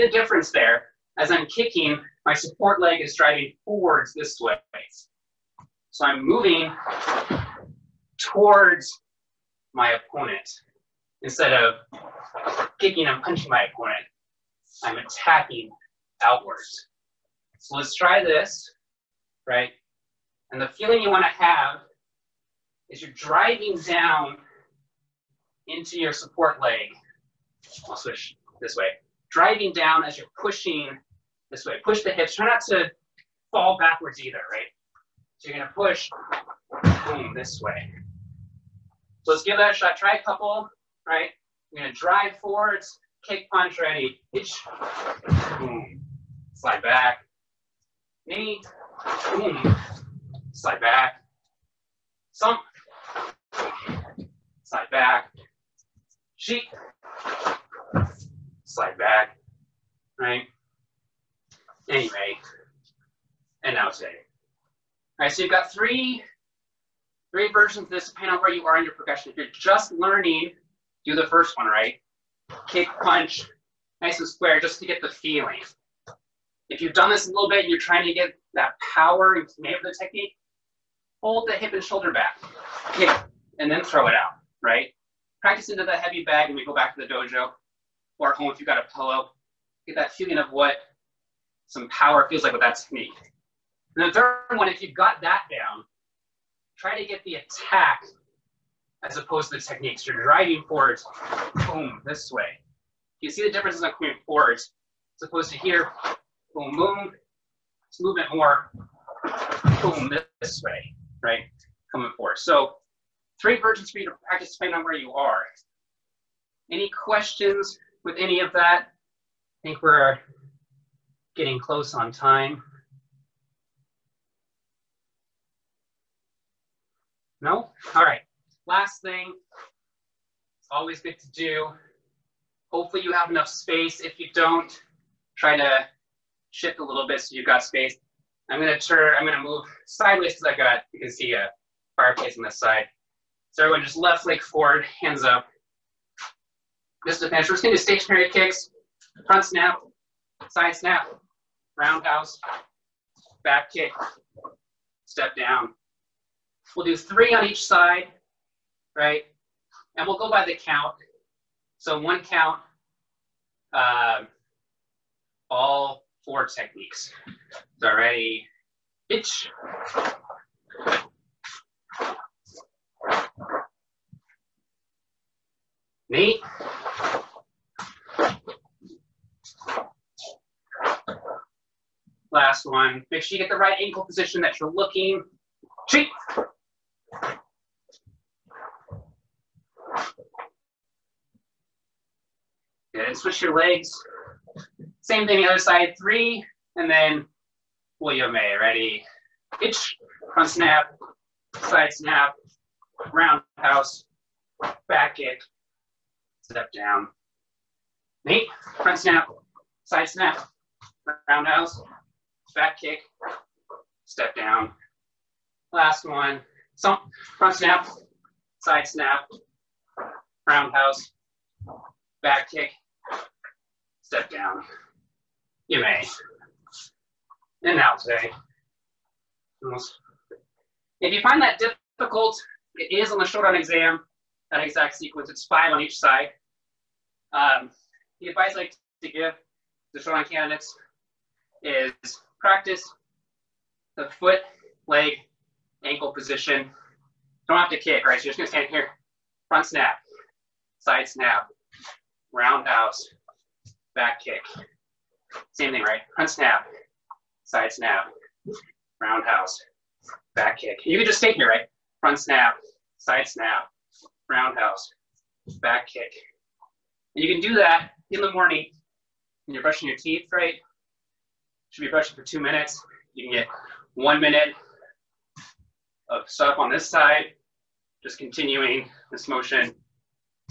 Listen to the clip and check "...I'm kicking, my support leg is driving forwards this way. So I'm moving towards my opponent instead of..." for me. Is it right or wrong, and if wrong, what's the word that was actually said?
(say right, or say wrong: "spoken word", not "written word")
right.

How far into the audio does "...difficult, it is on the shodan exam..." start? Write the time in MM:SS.
03:51.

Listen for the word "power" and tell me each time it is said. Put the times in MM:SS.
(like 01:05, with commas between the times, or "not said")
01:18, 01:31.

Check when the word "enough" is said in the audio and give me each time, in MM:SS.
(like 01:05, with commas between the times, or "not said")
02:13.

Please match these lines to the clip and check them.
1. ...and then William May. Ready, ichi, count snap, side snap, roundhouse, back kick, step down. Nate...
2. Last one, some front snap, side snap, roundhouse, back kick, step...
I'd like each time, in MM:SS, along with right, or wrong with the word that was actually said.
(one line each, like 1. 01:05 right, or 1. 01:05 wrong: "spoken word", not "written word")
1. 03:16 wrong: "front", not "count"
2. 03:35 right.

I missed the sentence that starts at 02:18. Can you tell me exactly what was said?
I'm gonna turn, I'm gonna move sideways because I got, you can see a fireplace on this side.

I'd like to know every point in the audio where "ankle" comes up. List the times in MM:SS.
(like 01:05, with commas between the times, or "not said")
03:03, 04:05.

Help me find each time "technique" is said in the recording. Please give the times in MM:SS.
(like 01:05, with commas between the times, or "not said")
01:19, 01:32, 01:39, 02:46.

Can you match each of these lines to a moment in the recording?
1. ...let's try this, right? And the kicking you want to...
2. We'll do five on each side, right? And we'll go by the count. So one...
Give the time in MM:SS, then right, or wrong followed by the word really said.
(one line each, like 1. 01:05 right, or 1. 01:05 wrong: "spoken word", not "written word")
1. 00:17 wrong: "feeling", not "kicking"
2. 02:36 wrong: "three", not "five".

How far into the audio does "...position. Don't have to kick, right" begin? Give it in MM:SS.
04:06.